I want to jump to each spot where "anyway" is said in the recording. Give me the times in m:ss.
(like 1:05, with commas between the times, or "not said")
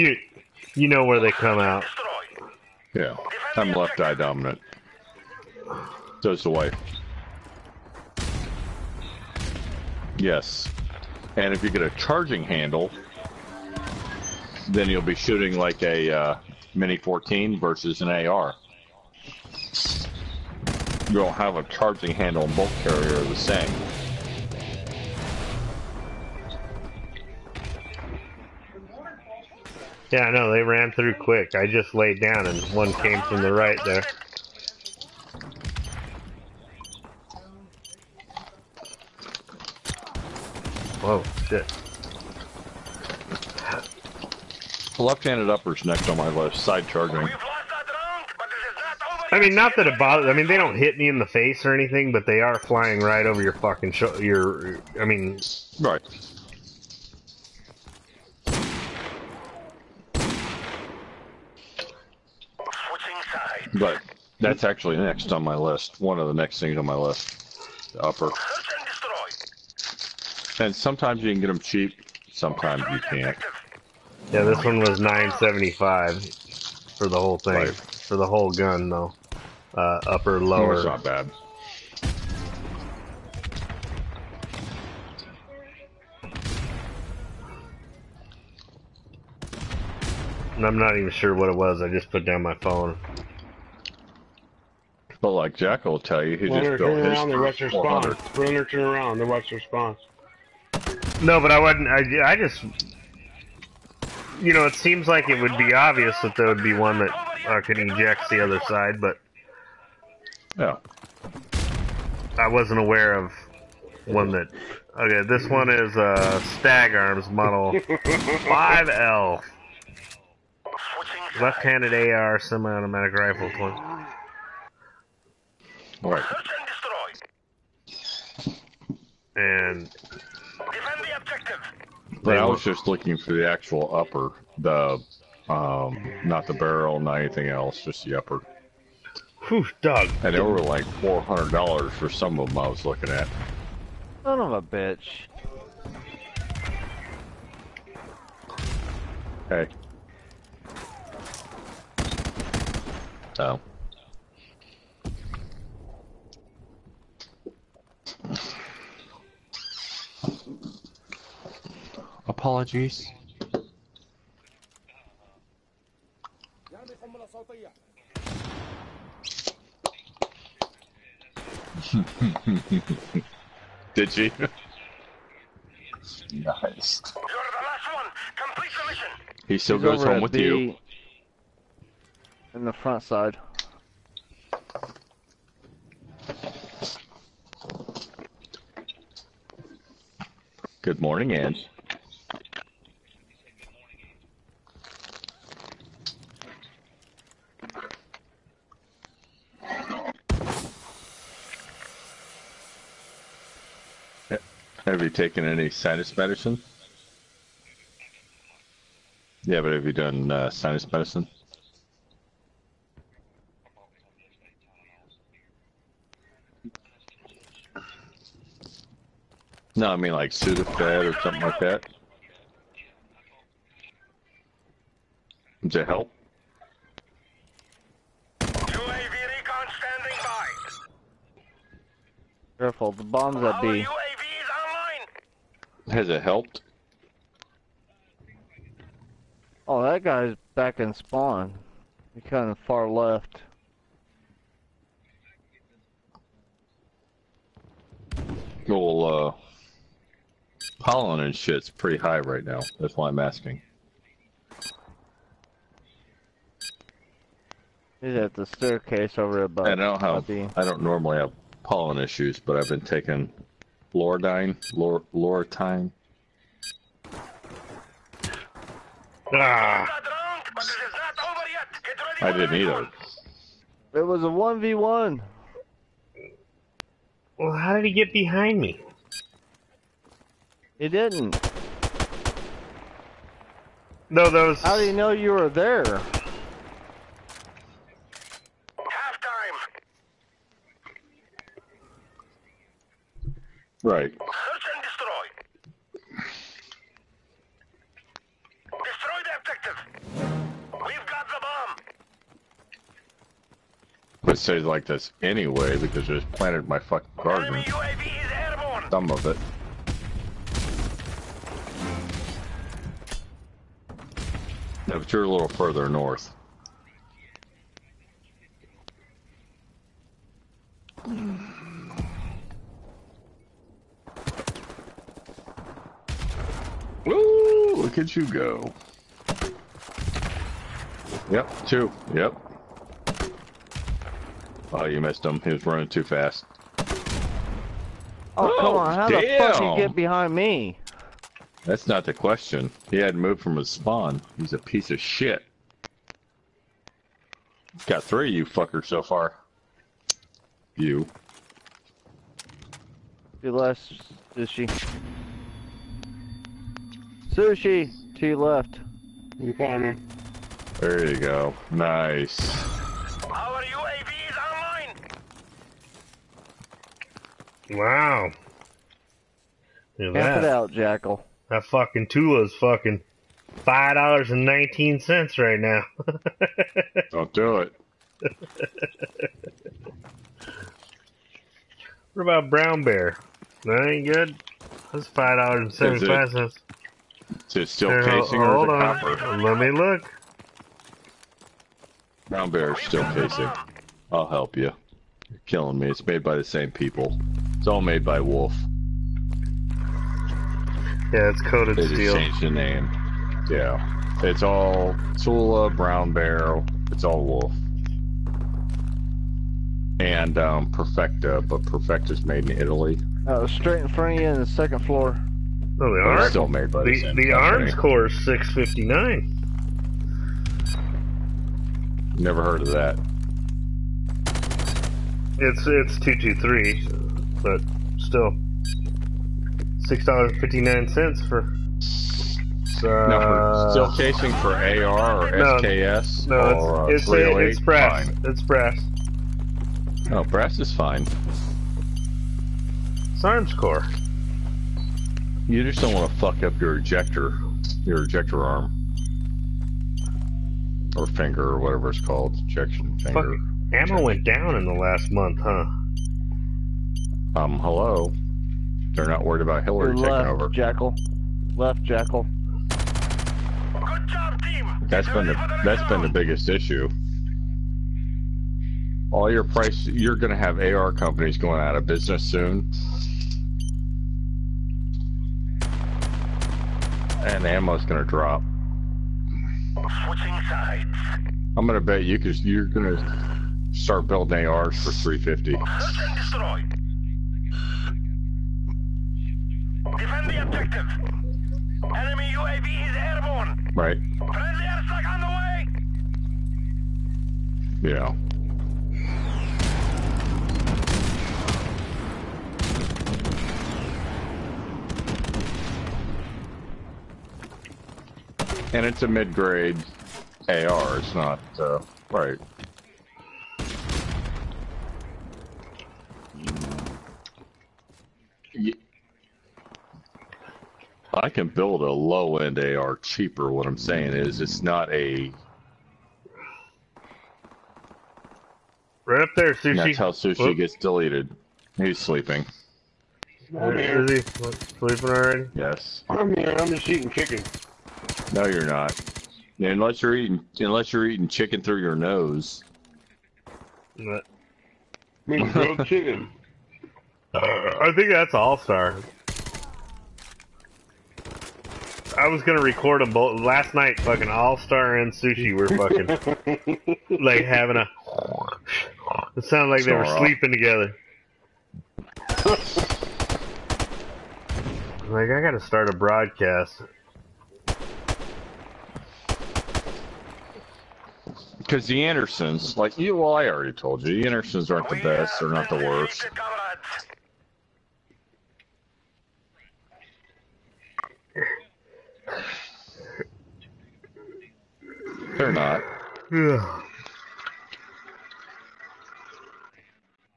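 5:05.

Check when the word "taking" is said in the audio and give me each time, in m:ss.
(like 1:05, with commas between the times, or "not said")
4:22, 7:40.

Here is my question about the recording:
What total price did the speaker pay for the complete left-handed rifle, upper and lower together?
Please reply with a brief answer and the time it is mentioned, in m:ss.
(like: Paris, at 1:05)
$975, at 1:14.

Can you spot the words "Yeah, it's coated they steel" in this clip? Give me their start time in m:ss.
6:41.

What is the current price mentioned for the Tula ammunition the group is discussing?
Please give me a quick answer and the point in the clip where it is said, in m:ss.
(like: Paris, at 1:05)
$5.19, at 6:13.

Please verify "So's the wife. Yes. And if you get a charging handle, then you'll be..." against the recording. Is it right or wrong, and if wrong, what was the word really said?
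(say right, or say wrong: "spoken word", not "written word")
right.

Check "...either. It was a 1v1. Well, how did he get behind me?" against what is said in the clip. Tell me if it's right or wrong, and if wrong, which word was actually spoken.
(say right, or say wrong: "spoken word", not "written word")
right.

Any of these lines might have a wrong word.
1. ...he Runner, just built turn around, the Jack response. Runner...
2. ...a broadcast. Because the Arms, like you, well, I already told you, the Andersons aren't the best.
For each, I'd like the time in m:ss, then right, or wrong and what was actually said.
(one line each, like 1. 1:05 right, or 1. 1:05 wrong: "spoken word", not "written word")
1. 1:36 wrong: "West", not "Jack"
2. 9:25 wrong: "Andersons", not "Arms".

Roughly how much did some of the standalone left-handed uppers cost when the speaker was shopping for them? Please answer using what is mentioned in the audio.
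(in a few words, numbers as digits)
$400.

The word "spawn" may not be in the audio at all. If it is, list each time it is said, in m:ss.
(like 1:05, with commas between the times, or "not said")
4:00, 5:43.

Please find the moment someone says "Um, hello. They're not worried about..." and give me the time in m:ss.
7:37.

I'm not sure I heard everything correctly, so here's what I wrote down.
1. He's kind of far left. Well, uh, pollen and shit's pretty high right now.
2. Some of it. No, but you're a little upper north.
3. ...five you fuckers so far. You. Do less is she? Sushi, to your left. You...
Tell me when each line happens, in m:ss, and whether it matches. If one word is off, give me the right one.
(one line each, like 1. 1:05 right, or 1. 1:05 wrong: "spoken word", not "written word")
1. 4:02 right
2. 5:08 wrong: "further", not "upper"
3. 5:48 wrong: "three", not "five".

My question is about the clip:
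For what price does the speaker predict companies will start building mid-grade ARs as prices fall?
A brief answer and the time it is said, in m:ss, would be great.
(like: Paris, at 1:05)
$350, at 8:04.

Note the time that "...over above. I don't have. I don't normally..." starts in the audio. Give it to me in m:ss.
4:19.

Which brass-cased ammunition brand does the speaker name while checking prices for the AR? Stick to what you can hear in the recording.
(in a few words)
Armscor.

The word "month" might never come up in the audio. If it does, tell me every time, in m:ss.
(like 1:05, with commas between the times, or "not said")
7:35.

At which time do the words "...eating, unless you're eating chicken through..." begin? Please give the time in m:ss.
9:00.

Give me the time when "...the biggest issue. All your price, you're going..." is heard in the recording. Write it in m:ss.
7:46.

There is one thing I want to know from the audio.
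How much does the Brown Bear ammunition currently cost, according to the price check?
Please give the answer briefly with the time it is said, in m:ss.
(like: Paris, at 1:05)
$5.75, at 6:25.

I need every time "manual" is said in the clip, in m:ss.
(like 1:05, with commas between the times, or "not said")
not said.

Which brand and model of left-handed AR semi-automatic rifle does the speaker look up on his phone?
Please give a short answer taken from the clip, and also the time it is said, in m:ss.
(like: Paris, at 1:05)
Stag Arms Model 5L, at 1:56.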